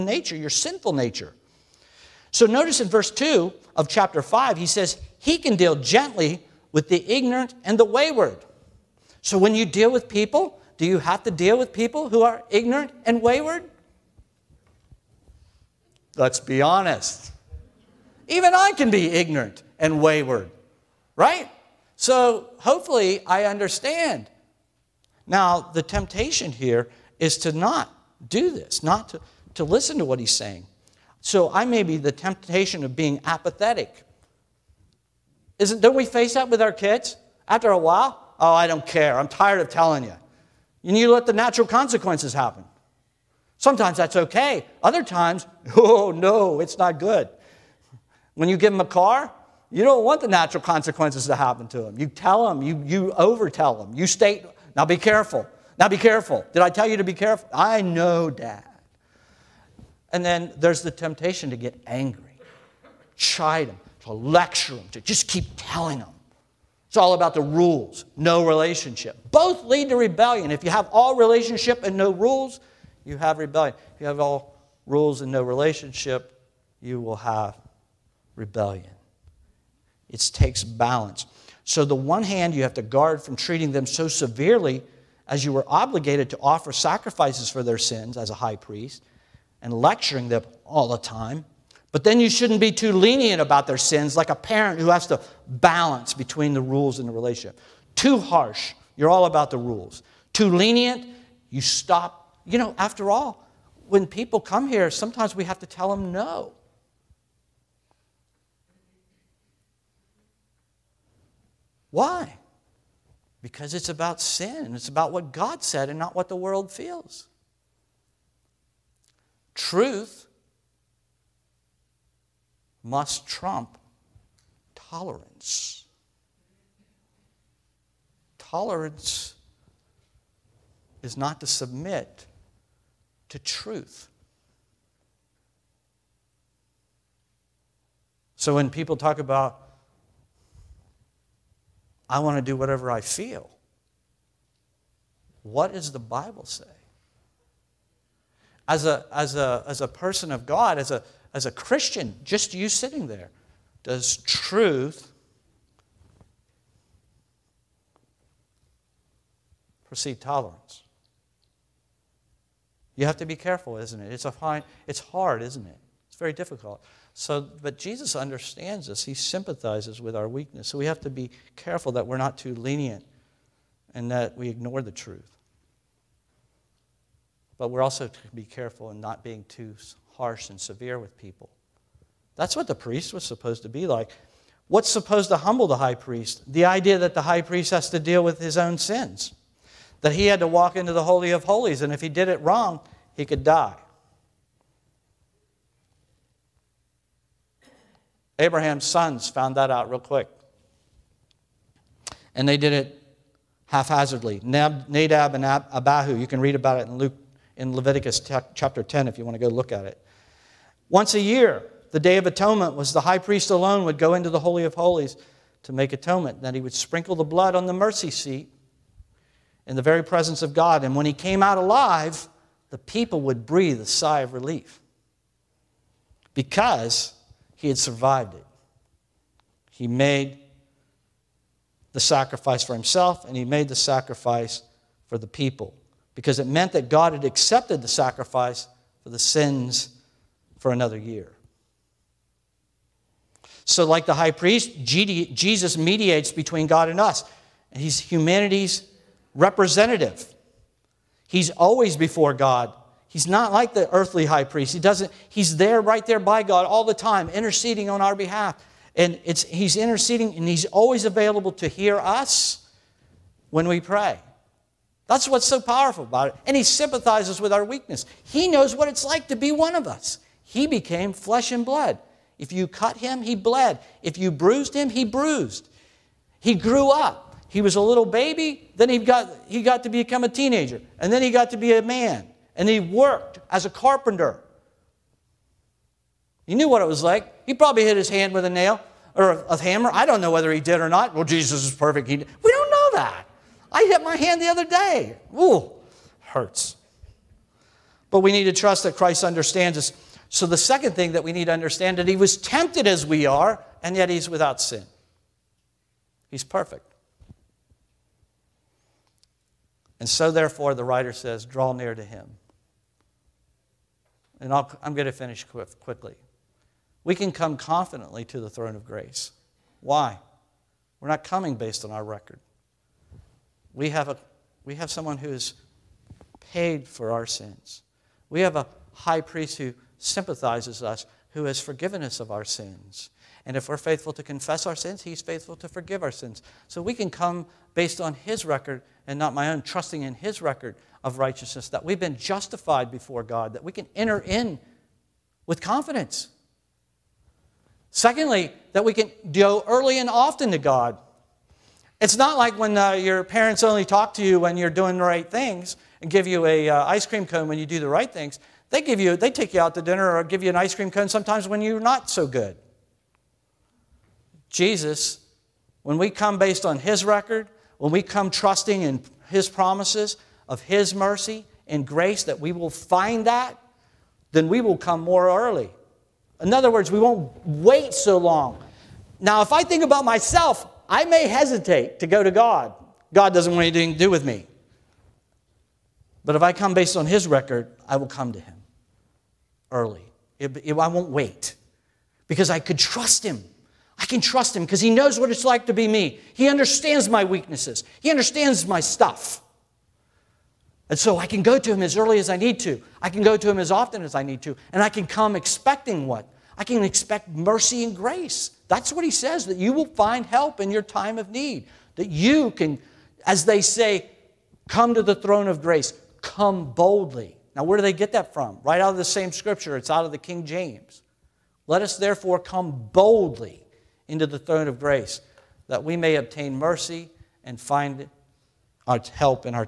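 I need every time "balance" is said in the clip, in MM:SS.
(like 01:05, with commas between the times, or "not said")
01:20, 01:35.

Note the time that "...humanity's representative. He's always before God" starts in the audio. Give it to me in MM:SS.
04:07.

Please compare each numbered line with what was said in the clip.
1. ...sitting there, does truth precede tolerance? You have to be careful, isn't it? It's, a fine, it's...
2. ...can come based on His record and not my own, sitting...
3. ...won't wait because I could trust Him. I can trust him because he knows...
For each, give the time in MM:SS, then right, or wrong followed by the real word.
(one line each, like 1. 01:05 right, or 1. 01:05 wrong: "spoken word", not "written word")
1. 02:32 right
2. 05:36 wrong: "trusting", not "sitting"
3. 06:30 right.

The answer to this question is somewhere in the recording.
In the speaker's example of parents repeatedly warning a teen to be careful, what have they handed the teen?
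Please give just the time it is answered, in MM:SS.
00:48.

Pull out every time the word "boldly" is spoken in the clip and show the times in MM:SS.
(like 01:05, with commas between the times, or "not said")
06:56, 07:02.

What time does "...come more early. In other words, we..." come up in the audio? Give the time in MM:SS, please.
06:14.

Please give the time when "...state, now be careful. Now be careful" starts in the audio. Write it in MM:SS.
00:54.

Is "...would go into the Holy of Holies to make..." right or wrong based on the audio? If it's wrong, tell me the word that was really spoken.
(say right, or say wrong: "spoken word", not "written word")
right.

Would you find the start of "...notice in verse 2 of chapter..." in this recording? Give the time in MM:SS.
00:02.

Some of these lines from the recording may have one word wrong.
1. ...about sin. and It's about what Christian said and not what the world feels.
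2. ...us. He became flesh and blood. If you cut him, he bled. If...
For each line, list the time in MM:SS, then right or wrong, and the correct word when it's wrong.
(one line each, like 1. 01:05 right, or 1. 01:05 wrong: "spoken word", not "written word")
1. 01:53 wrong: "God", not "Christian"
2. 04:29 right.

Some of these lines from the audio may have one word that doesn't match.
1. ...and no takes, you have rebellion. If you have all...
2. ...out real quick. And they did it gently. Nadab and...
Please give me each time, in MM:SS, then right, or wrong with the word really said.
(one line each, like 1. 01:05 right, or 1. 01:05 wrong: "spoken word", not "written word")
1. 01:11 wrong: "rules", not "takes"
2. 03:19 wrong: "haphazardly", not "gently".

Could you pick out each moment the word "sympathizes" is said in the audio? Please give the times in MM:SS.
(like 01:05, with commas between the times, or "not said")
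02:49, 04:26, 05:29.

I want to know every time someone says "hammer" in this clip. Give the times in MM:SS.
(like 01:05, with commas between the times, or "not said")
04:49.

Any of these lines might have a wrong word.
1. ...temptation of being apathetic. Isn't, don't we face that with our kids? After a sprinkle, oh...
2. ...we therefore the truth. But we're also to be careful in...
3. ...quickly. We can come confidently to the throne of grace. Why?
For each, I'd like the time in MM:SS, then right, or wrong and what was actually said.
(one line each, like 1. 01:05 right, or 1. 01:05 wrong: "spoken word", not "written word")
1. 00:32 wrong: "while", not "sprinkle"
2. 02:54 wrong: "ignore", not "therefore"
3. 05:15 right.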